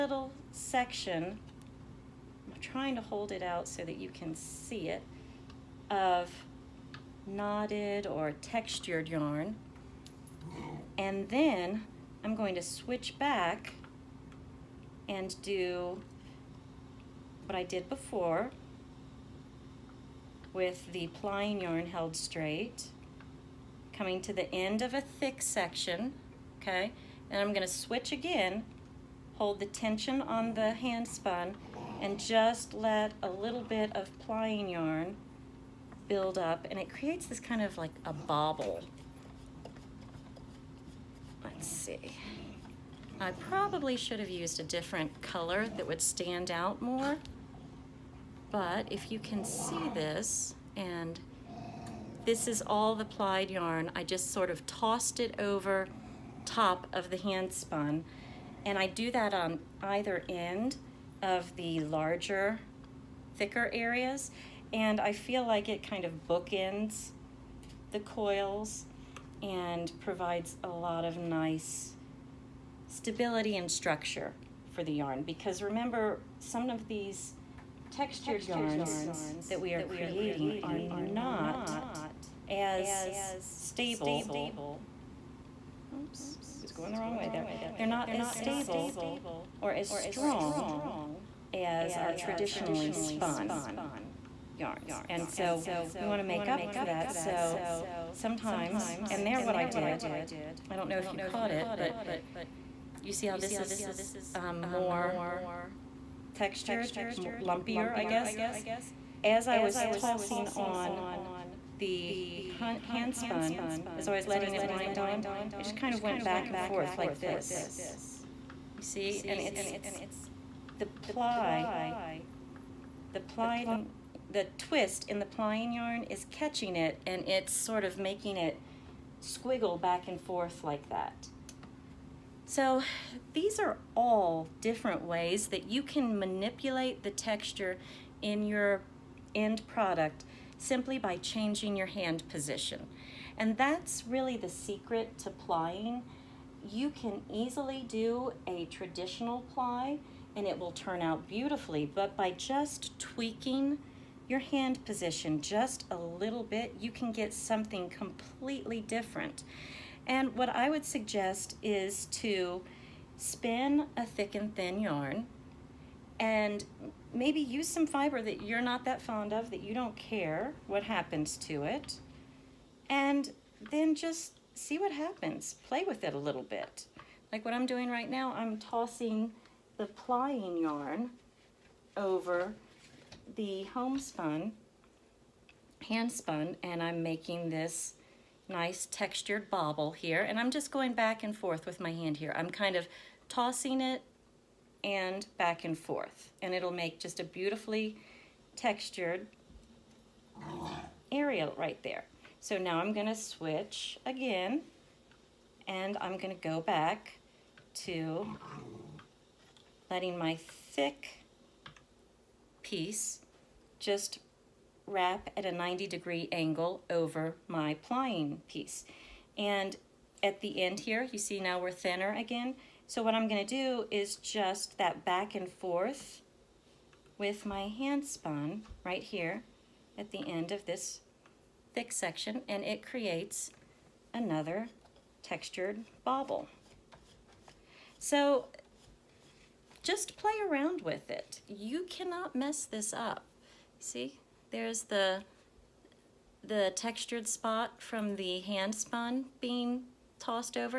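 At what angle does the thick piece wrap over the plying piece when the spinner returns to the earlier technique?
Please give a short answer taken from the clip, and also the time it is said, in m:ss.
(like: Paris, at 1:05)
90 degrees, at 3:35.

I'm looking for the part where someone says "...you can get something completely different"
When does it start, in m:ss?
2:36.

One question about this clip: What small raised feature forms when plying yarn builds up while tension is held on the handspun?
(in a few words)
a bobble.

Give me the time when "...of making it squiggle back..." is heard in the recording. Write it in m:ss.
2:07.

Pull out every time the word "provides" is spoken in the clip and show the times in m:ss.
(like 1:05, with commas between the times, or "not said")
1:10.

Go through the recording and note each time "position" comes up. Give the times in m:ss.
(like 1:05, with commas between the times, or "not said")
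2:22, 2:34.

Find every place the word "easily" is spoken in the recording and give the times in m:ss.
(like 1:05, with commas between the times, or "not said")
2:27.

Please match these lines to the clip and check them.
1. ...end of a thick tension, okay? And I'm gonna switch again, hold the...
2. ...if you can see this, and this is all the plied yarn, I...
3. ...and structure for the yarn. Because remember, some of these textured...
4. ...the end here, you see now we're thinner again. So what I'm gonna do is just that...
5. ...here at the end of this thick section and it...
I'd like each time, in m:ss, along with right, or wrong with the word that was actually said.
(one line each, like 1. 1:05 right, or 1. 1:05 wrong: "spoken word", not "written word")
1. 0:24 wrong: "section", not "tension"
2. 0:48 right
3. 1:13 right
4. 3:40 right
5. 3:49 right.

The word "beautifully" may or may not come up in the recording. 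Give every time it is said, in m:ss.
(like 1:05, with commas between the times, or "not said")
2:31, 3:17.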